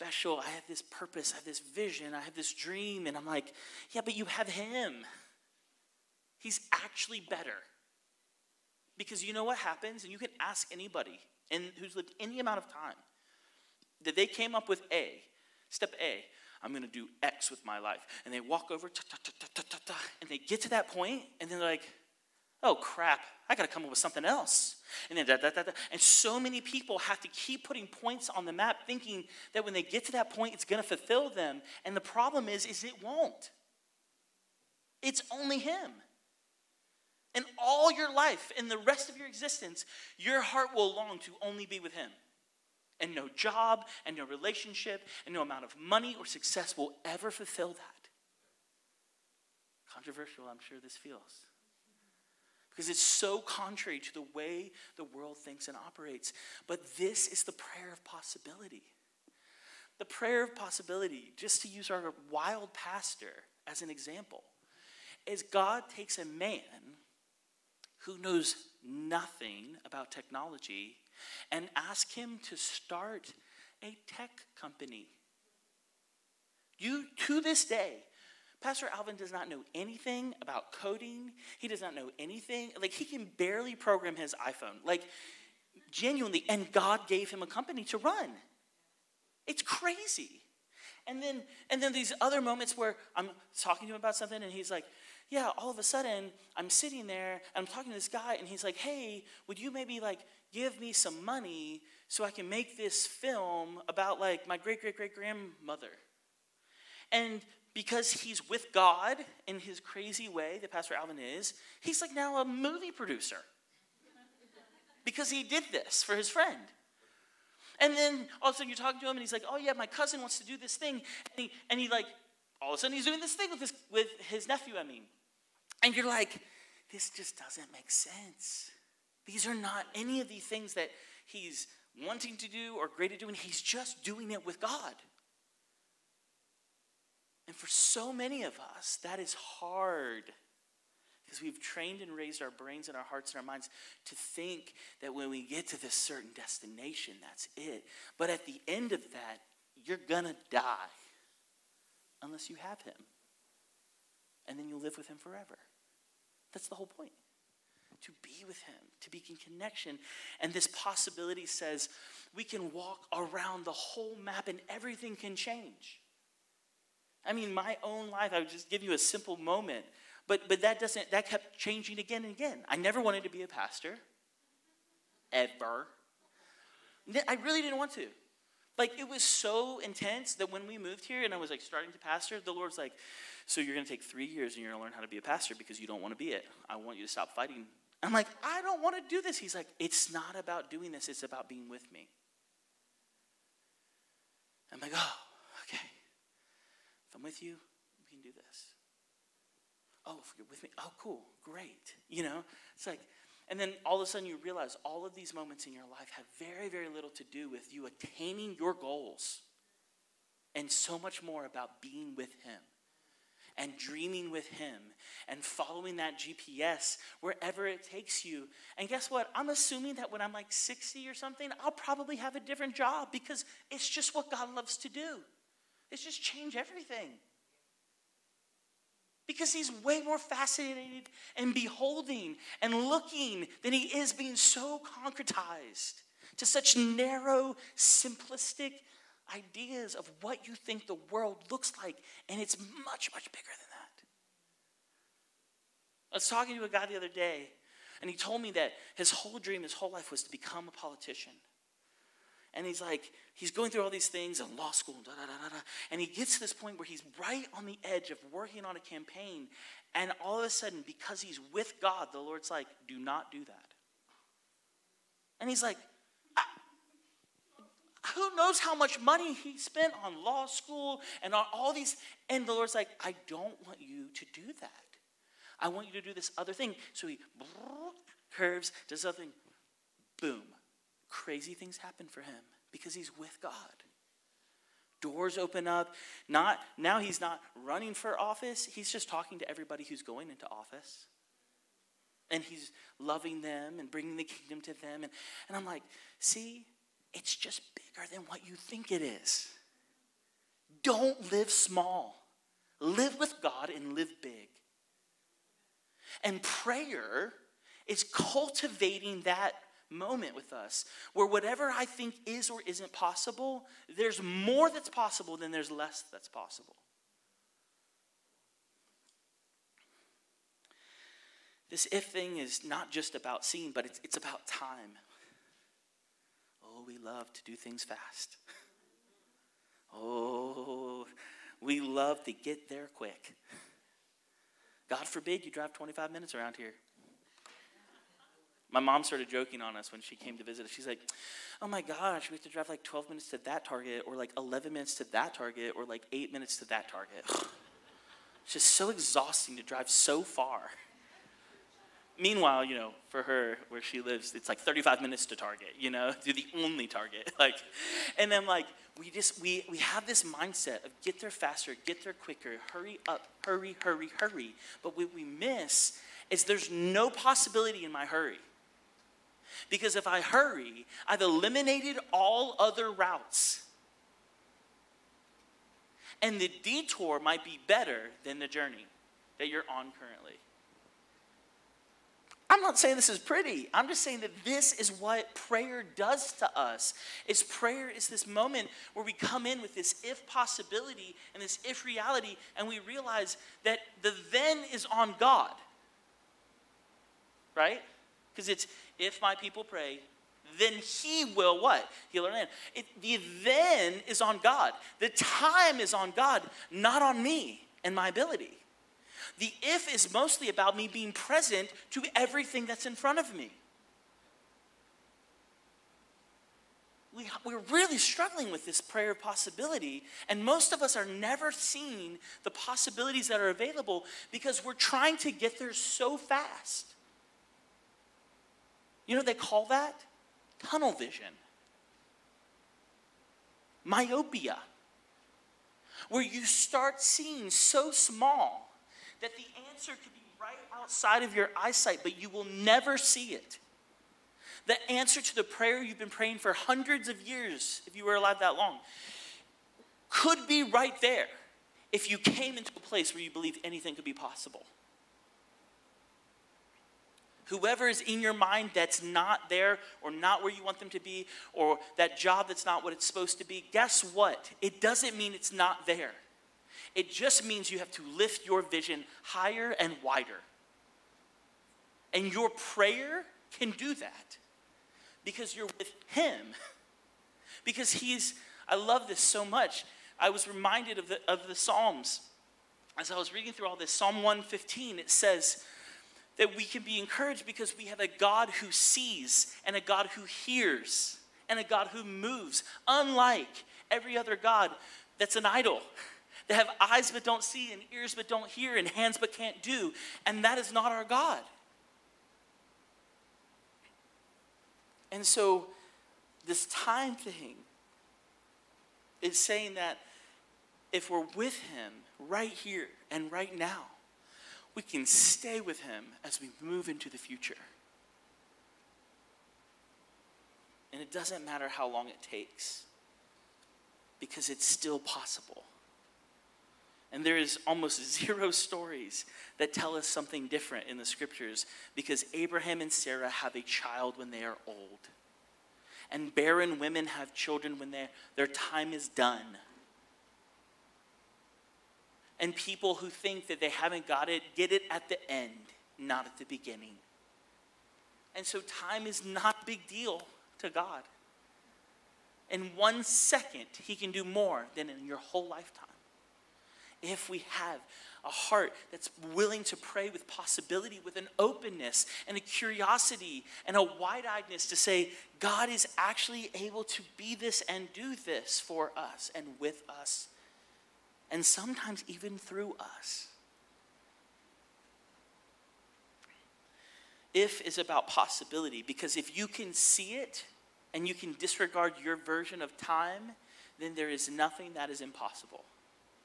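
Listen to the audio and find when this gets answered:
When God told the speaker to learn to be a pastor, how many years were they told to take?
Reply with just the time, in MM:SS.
03:04.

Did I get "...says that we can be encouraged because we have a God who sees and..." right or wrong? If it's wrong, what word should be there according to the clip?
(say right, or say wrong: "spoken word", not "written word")
right.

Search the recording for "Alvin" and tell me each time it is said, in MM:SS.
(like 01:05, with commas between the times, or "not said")
01:18, 01:50.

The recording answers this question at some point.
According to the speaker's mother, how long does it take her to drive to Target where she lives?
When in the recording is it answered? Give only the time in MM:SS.
05:54.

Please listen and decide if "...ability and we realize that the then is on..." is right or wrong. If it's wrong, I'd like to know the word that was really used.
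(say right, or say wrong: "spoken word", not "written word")
wrong: "reality", not "ability".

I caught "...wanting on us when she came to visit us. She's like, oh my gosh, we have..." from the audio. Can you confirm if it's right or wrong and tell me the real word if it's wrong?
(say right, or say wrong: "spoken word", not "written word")
wrong: "joking", not "wanting".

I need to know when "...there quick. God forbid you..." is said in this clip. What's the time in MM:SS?
05:32.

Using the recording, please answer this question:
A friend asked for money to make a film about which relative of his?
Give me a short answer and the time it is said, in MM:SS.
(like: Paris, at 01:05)
great great great grandmother, at 01:44.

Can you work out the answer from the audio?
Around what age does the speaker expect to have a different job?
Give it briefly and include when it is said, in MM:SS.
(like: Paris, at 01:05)
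60, at 03:40.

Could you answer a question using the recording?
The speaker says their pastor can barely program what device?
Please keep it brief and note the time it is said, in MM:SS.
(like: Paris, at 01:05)
iPhone, at 01:24.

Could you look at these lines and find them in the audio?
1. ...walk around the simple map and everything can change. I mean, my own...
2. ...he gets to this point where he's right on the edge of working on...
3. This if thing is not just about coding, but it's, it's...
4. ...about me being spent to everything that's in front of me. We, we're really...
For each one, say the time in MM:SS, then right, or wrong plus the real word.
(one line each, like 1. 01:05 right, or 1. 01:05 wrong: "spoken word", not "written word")
1. 02:42 wrong: "whole", not "simple"
2. 04:16 right
3. 05:21 wrong: "seeing", not "coding"
4. 06:50 wrong: "present", not "spent".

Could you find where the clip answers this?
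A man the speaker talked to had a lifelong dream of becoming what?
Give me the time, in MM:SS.
04:10.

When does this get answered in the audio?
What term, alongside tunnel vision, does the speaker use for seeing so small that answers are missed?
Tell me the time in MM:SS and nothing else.
07:13.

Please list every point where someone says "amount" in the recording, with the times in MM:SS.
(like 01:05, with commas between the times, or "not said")
00:12, 00:45.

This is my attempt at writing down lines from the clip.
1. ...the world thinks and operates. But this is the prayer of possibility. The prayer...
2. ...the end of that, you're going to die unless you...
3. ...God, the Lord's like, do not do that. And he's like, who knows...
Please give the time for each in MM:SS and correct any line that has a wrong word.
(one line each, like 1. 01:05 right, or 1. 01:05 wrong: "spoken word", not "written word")
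1. 00:54 right
2. 02:28 right
3. 04:21 right.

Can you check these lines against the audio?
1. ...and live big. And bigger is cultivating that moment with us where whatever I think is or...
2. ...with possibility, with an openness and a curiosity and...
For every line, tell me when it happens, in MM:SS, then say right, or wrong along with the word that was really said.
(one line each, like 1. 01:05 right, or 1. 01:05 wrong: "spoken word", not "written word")
1. 05:03 wrong: "prayer", not "bigger"
2. 09:20 right.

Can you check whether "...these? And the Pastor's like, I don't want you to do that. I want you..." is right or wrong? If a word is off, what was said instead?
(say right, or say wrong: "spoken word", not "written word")
wrong: "Lord", not "Pastor".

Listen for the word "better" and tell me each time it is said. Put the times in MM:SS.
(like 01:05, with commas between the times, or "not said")
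00:07, 06:17.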